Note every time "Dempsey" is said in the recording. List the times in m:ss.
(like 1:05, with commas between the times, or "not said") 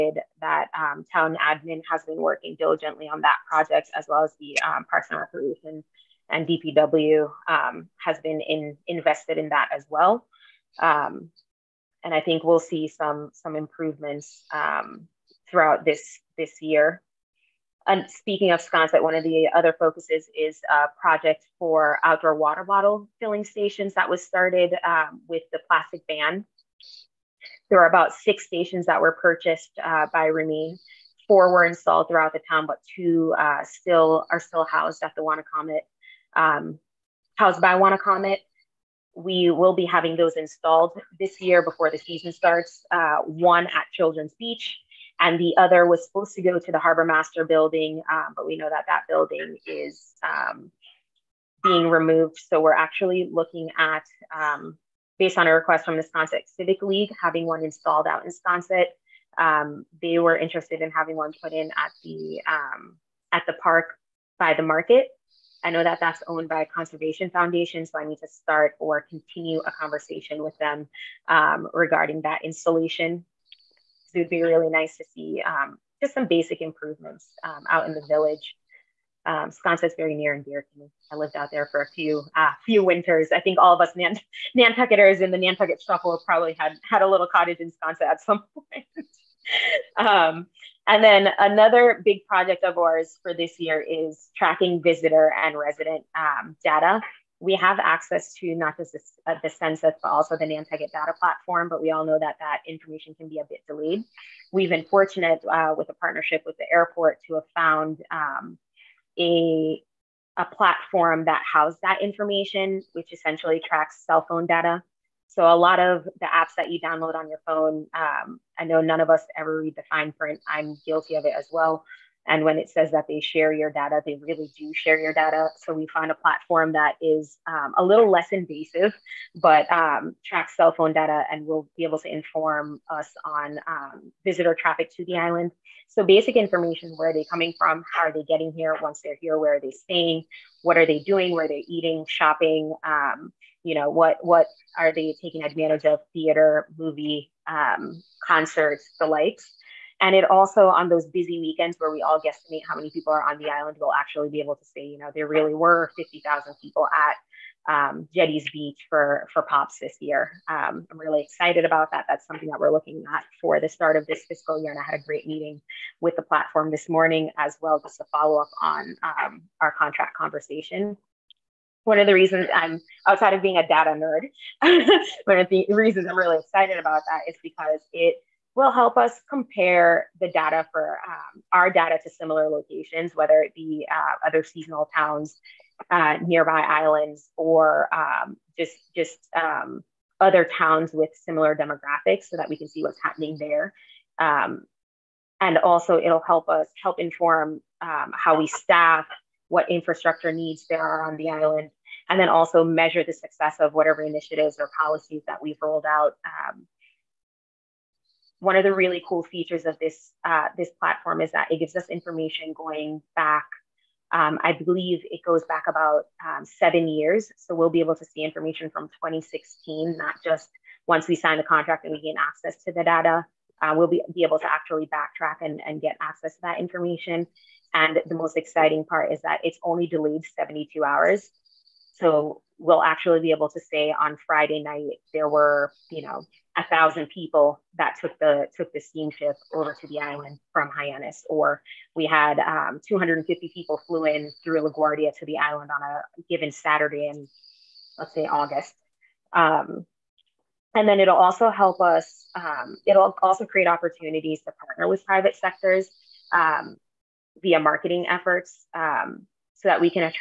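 not said.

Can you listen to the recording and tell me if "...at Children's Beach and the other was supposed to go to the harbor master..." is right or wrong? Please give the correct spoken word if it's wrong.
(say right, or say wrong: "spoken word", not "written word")
right.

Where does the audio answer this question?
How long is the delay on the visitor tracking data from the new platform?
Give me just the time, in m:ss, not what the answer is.
3:50.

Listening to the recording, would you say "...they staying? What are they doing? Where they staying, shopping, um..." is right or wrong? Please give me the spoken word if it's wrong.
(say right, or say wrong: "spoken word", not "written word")
wrong: "eating", not "staying".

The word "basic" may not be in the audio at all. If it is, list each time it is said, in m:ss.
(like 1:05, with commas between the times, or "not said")
1:16, 2:16.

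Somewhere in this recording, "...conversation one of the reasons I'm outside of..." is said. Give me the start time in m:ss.
2:50.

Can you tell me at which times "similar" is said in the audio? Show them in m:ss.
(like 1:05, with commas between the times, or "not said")
3:02, 3:11.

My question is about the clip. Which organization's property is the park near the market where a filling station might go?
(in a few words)
Conservation Foundation.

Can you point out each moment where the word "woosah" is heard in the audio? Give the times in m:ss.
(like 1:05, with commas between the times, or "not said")
not said.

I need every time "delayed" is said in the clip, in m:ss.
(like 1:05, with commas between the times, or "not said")
1:43, 3:49.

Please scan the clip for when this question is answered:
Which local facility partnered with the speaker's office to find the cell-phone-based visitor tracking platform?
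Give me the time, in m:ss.
1:46.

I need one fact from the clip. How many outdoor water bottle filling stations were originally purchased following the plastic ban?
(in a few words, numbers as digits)
6.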